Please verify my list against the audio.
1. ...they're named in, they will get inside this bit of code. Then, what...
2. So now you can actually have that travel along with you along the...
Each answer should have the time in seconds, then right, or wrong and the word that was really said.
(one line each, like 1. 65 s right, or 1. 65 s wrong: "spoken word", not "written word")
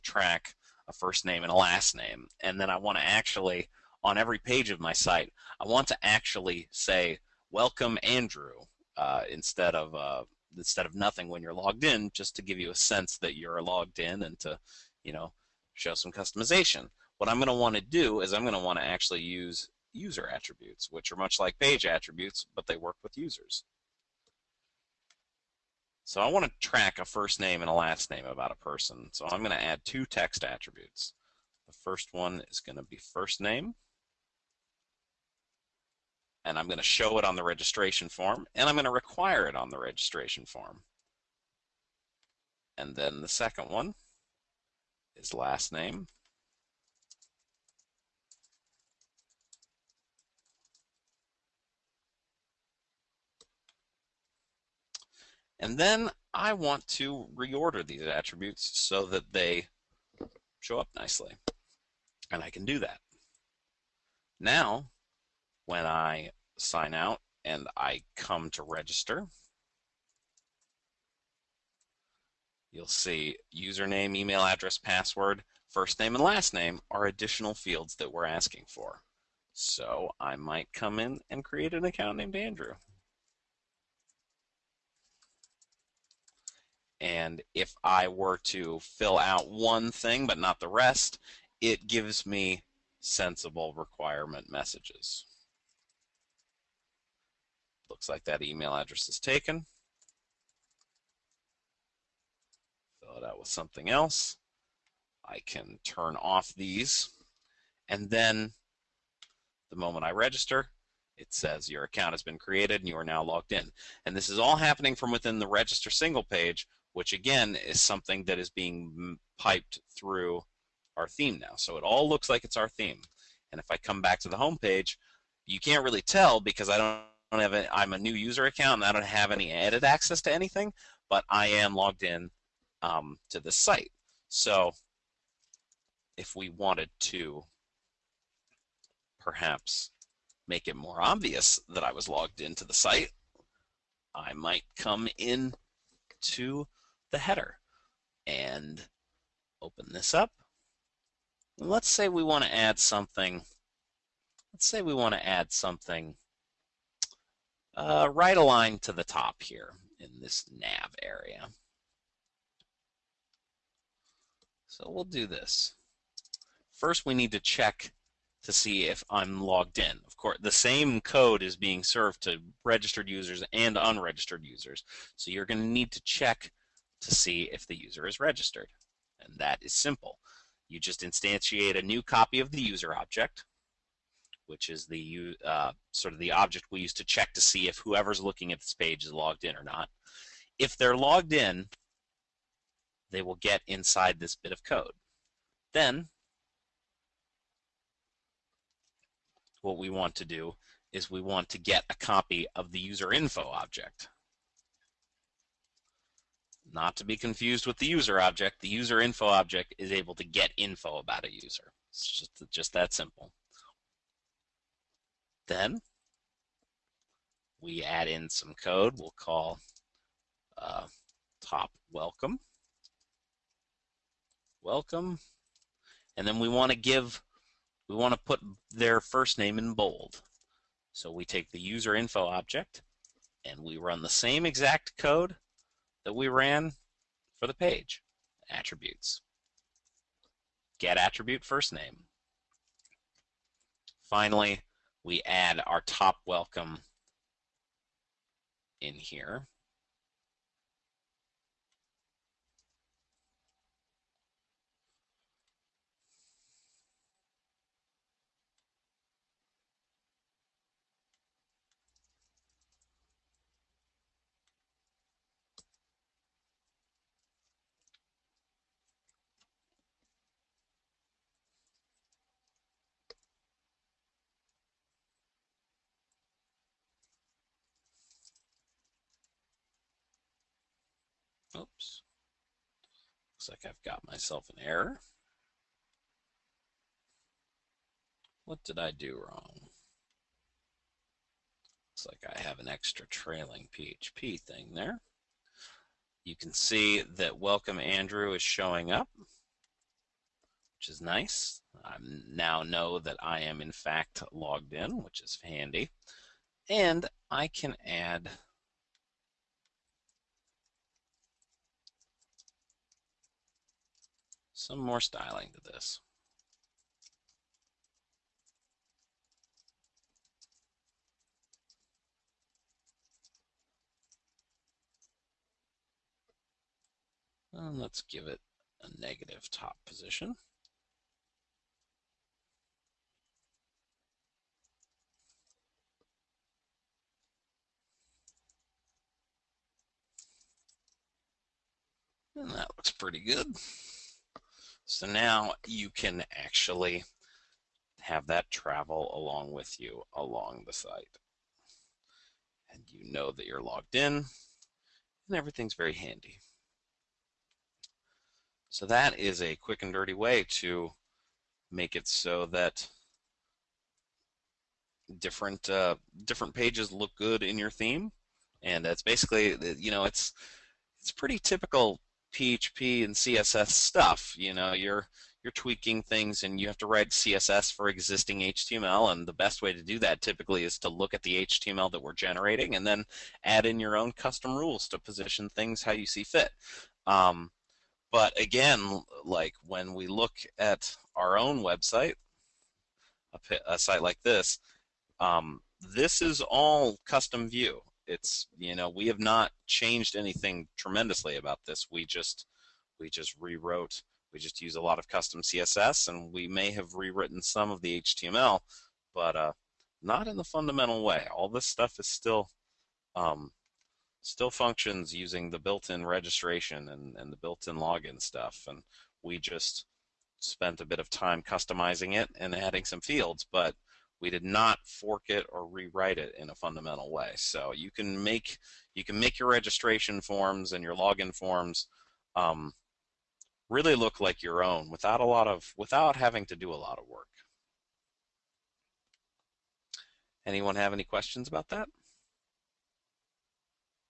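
1. 190 s wrong: "logged", not "named"
2. 344 s right.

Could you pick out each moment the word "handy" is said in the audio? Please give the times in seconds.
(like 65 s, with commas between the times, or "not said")
305 s, 355 s.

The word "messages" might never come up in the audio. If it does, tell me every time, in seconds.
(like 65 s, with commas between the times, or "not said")
94 s.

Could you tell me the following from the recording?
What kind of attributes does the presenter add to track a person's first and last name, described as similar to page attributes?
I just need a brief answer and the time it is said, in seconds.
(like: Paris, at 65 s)
Text attributes, at 30 s.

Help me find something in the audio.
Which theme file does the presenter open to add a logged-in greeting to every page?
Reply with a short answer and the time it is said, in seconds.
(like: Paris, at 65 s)
The header, at 147 s.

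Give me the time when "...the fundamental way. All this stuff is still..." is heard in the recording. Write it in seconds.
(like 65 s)
410 s.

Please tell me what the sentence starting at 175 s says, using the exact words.
So you're going to need to check to see if the user is registered.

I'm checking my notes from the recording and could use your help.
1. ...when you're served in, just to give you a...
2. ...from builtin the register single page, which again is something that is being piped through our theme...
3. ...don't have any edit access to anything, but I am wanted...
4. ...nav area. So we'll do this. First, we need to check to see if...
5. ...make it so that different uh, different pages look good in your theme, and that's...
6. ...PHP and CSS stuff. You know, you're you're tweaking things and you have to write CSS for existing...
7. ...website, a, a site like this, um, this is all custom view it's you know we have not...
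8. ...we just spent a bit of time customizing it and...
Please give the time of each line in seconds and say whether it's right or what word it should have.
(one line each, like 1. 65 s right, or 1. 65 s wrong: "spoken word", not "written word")
1. 11 s wrong: "logged", not "served"
2. 114 s wrong: "within", not "builtin"
3. 128 s wrong: "logged", not "wanted"
4. 160 s right
5. 361 s right
6. 372 s right
7. 391 s right
8. 419 s right.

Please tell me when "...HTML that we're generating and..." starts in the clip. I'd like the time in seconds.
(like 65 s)
381 s.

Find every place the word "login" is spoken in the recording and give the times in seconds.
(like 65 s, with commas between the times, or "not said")
417 s, 430 s.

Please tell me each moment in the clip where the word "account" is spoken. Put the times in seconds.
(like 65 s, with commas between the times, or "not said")
81 s, 111 s, 128 s.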